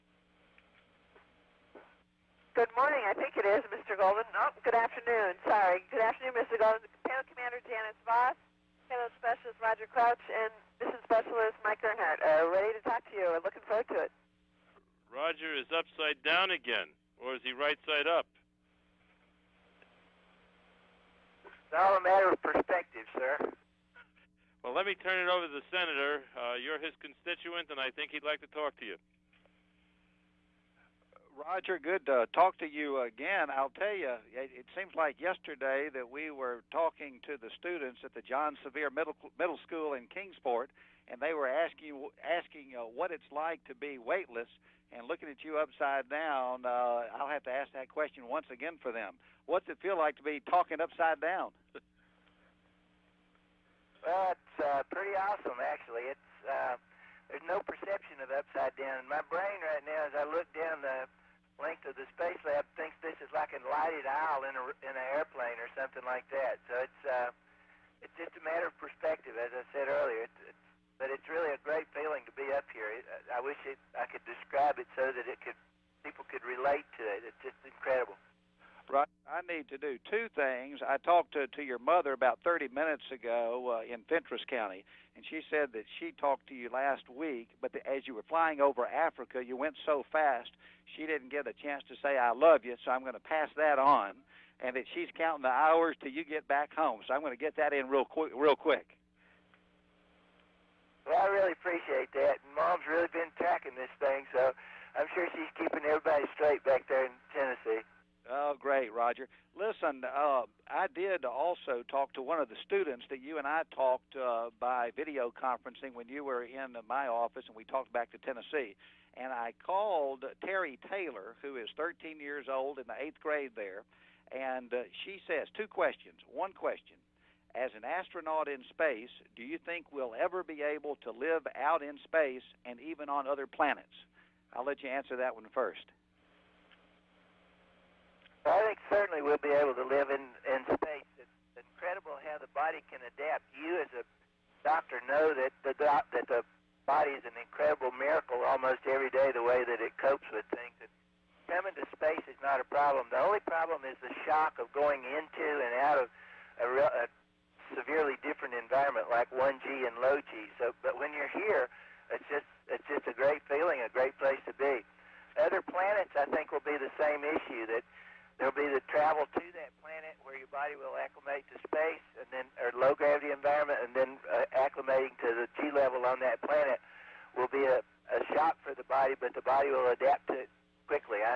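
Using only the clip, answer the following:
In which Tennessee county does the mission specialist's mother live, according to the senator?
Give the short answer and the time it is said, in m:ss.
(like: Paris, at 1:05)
Fentress County, at 1:24.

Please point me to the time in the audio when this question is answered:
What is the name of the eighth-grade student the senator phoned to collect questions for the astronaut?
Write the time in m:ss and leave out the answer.
2:00.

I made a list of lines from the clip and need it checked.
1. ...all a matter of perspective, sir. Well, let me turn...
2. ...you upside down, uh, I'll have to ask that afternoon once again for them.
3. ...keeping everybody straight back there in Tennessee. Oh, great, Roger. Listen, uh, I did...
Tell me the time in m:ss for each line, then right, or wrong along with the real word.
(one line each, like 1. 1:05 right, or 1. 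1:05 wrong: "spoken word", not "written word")
1. 0:21 right
2. 0:45 wrong: "question", not "afternoon"
3. 1:45 right.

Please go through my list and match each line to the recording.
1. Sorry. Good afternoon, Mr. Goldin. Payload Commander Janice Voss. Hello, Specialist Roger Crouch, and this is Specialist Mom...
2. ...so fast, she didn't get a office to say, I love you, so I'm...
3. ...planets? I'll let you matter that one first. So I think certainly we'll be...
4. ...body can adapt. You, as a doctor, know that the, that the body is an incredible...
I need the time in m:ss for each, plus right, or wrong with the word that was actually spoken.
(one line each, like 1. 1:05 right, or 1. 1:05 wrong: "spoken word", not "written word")
1. 0:05 wrong: "Mike", not "Mom"
2. 1:29 wrong: "chance", not "office"
3. 2:13 wrong: "answer", not "matter"
4. 2:22 right.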